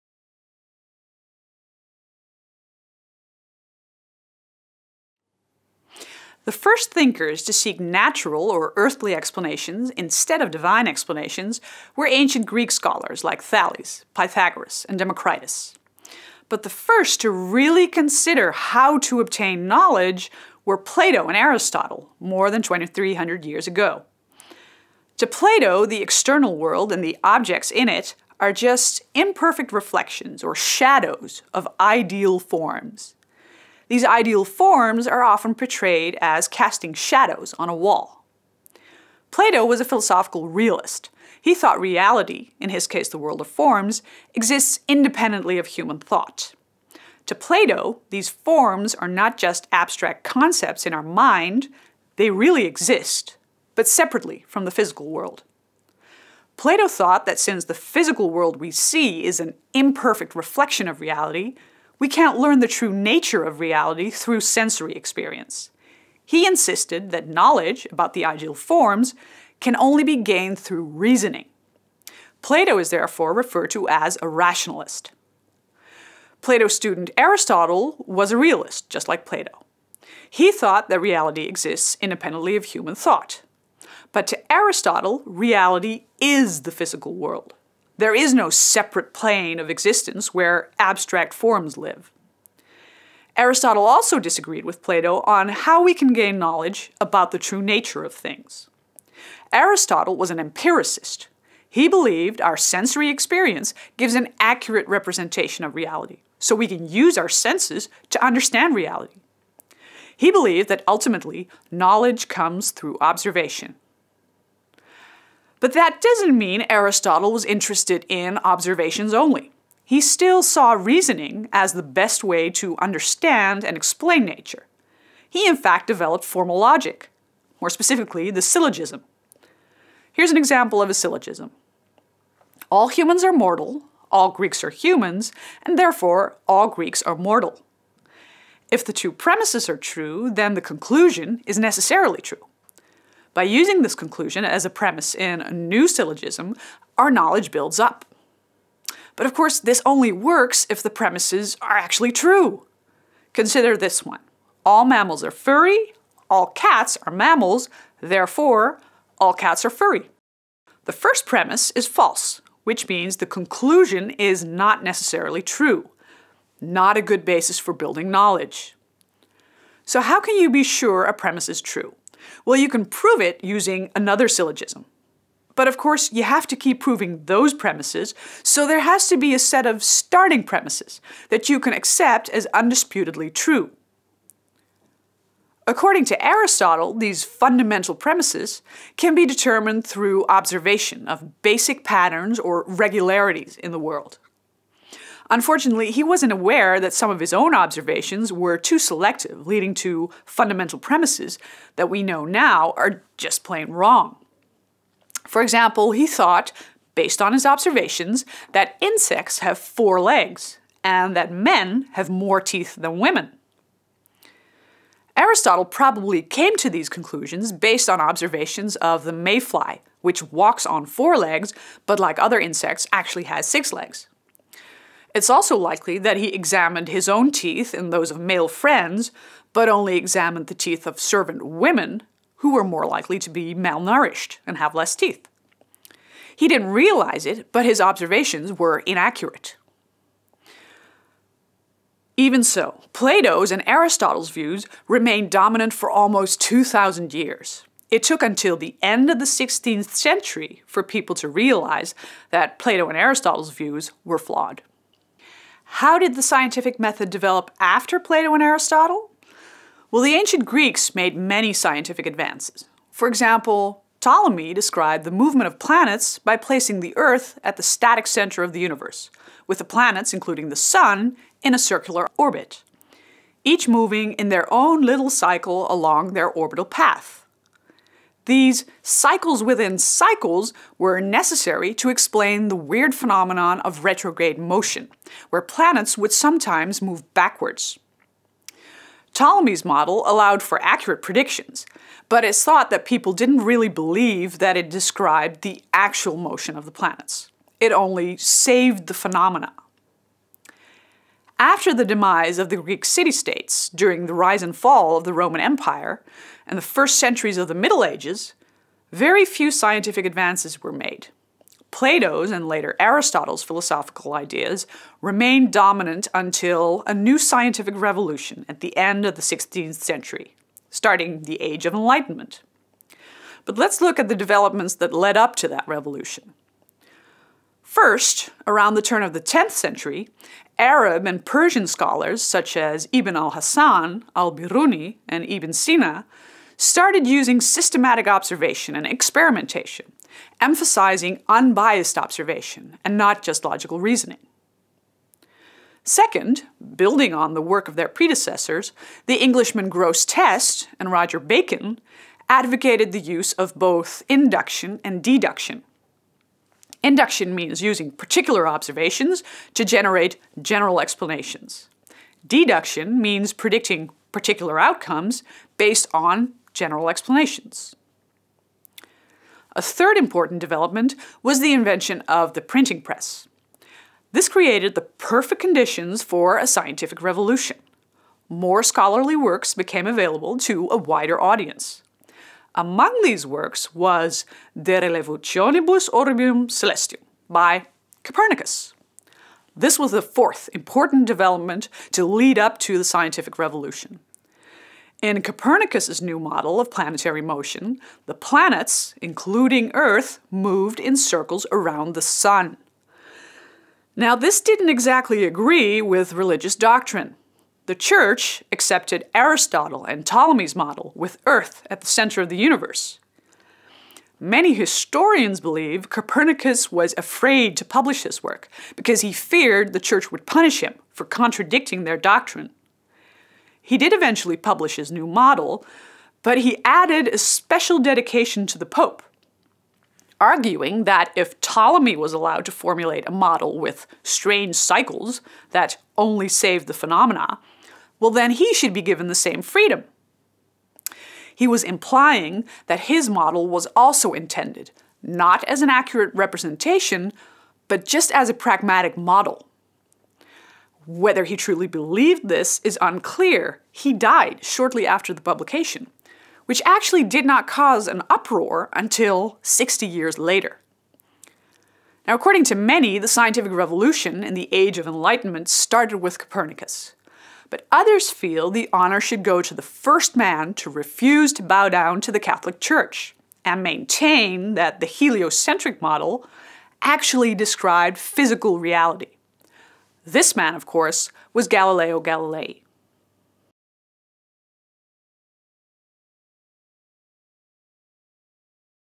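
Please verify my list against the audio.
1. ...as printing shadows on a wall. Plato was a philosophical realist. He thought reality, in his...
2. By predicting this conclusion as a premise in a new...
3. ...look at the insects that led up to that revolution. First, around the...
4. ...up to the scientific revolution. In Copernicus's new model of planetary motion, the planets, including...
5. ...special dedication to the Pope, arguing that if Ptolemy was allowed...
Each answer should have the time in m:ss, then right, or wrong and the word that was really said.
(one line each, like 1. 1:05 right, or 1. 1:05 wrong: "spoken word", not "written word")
1. 0:36 wrong: "casting", not "printing"
2. 2:23 wrong: "using", not "predicting"
3. 5:23 wrong: "developments", not "insects"
4. 6:32 right
5. 7:07 right.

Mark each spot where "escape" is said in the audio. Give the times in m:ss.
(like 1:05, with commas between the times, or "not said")
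not said.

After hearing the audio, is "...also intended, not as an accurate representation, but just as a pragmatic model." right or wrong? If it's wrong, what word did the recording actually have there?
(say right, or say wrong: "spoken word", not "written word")
right.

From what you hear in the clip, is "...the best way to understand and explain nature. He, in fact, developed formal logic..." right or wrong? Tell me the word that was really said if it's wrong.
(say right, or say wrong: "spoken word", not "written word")
right.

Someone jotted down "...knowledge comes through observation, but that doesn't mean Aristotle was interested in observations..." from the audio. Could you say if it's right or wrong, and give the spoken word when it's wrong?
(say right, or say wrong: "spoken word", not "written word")
right.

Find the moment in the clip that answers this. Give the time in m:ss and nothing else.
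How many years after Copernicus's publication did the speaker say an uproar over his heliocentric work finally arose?
7:39.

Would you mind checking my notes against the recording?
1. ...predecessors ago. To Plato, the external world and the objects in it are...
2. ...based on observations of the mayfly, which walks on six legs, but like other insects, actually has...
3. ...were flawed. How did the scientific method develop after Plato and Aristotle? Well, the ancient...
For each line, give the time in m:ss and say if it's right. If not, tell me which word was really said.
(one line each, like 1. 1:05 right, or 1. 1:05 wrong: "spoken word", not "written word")
1. 0:23 wrong: "years", not "predecessors"
2. 3:37 wrong: "four", not "six"
3. 4:14 right.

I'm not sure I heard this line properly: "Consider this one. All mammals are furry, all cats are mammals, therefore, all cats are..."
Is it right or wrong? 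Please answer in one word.
right.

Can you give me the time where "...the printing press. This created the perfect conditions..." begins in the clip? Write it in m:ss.
6:12.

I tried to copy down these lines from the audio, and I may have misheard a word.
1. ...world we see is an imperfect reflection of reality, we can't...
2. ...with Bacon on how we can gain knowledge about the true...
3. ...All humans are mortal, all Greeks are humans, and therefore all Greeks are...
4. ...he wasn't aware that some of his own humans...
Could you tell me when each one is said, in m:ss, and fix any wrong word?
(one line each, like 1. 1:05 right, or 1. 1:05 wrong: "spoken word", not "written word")
1. 0:58 right
2. 1:34 wrong: "Plato", not "Bacon"
3. 2:12 right
4. 3:15 wrong: "observations", not "humans".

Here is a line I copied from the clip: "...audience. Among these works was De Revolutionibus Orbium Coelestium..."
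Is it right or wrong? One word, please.
right.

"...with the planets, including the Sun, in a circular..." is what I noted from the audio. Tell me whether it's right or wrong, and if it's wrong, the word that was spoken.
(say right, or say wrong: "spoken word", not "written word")
right.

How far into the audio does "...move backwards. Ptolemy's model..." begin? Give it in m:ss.
4:46.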